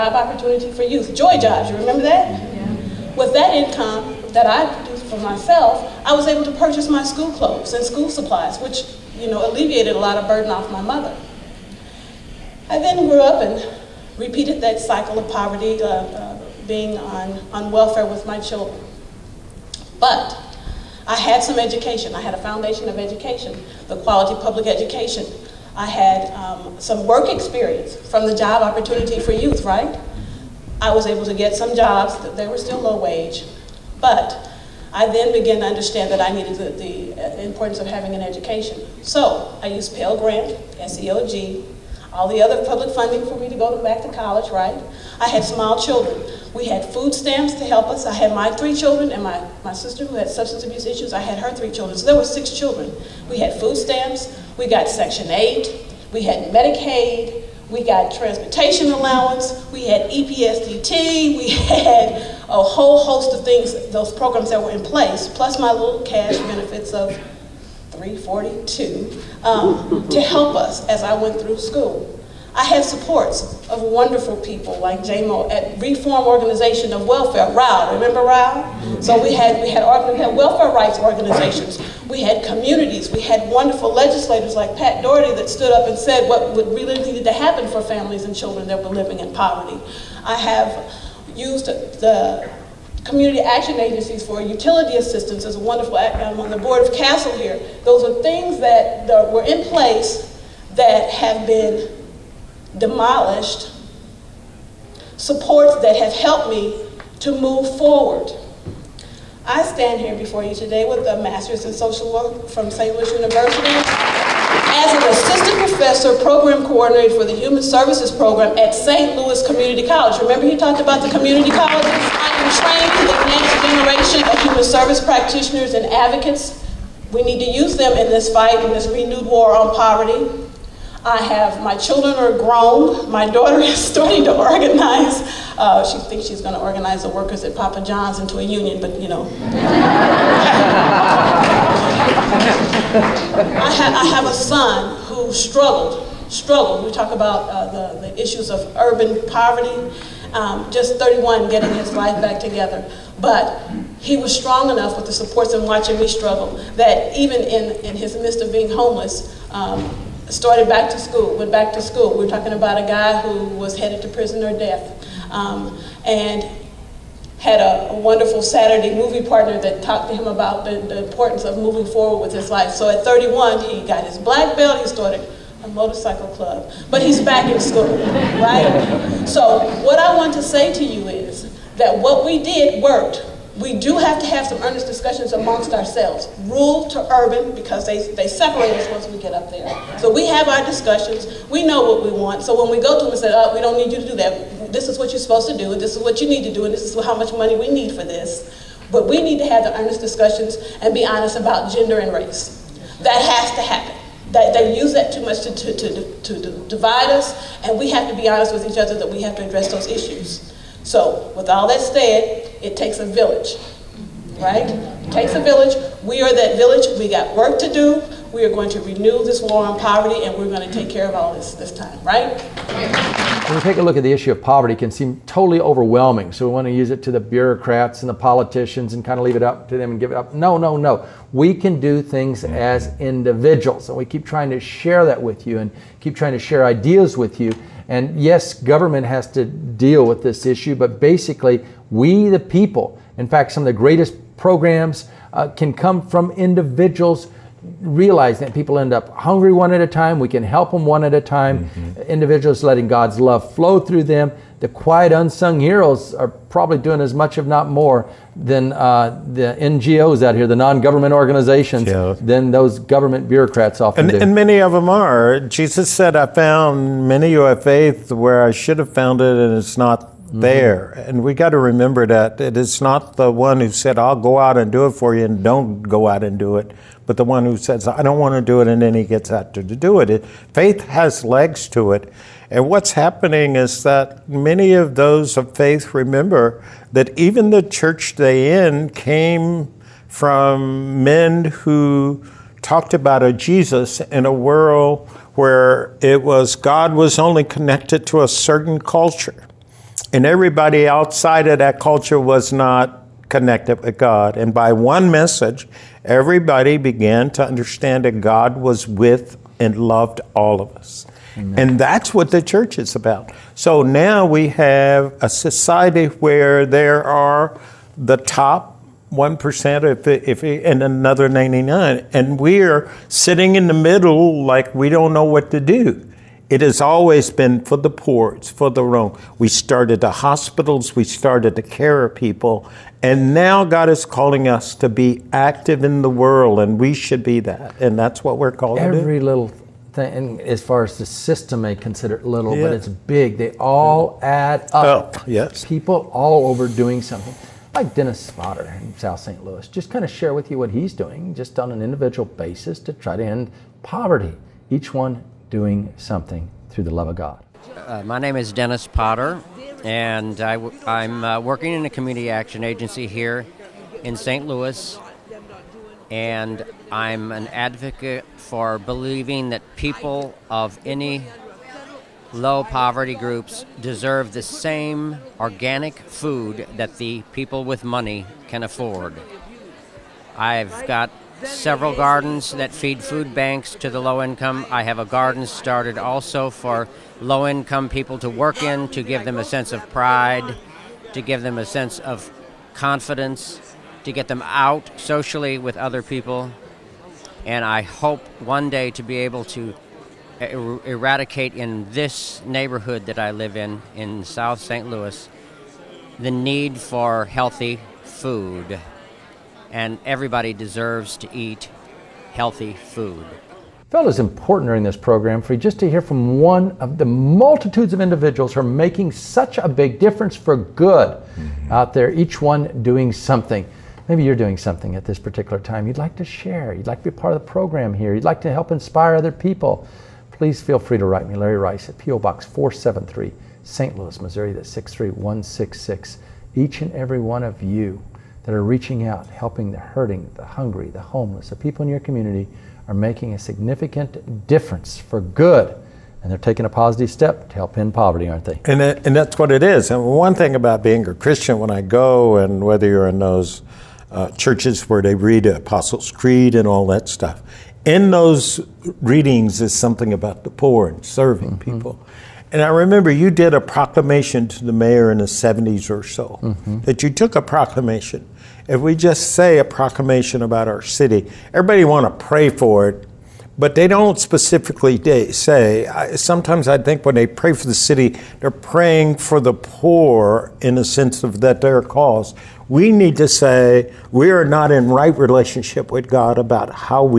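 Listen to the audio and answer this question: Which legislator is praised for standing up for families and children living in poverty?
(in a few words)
Pat Dougherty.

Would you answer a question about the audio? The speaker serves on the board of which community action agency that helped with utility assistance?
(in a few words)
CASTLE.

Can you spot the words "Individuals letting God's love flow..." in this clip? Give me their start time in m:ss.
4:12.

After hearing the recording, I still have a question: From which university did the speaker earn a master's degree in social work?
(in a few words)
St. Louis University.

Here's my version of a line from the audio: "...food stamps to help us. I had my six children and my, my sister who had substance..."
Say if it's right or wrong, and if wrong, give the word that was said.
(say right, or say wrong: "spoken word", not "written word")
wrong: "three", not "six".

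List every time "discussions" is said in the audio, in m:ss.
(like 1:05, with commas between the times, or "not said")
3:04, 3:10, 3:19.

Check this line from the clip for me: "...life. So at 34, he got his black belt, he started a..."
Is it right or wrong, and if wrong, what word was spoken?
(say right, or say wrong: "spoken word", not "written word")
wrong: "31", not "34".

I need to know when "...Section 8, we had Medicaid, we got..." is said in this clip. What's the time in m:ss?
0:54.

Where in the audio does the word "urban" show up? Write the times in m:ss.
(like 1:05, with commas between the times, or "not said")
2:28, 3:07.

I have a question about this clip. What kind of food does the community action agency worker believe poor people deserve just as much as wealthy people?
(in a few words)
organic food.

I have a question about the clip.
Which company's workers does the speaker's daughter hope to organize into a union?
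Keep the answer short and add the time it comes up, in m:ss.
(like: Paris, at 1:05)
Papa John's, at 2:17.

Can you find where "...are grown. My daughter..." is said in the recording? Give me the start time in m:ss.
2:12.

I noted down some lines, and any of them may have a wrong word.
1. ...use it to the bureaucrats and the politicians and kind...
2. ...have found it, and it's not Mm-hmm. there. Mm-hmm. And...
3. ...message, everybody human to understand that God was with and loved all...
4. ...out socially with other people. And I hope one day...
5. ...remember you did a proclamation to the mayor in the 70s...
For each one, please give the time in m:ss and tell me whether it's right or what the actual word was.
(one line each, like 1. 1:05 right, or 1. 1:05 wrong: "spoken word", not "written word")
1. 3:46 right
2. 4:28 right
3. 5:05 wrong: "began", not "human"
4. 6:34 right
5. 7:42 right.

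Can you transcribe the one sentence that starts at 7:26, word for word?
And they're taking a positive step to help end poverty, aren't they?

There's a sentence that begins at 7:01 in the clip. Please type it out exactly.
out there, each one doing something.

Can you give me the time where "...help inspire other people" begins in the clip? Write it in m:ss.
7:08.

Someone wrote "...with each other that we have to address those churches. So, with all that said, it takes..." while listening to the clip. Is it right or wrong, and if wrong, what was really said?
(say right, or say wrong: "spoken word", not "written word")
wrong: "issues", not "churches".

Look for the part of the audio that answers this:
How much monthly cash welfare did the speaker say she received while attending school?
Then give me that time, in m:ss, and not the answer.
1:07.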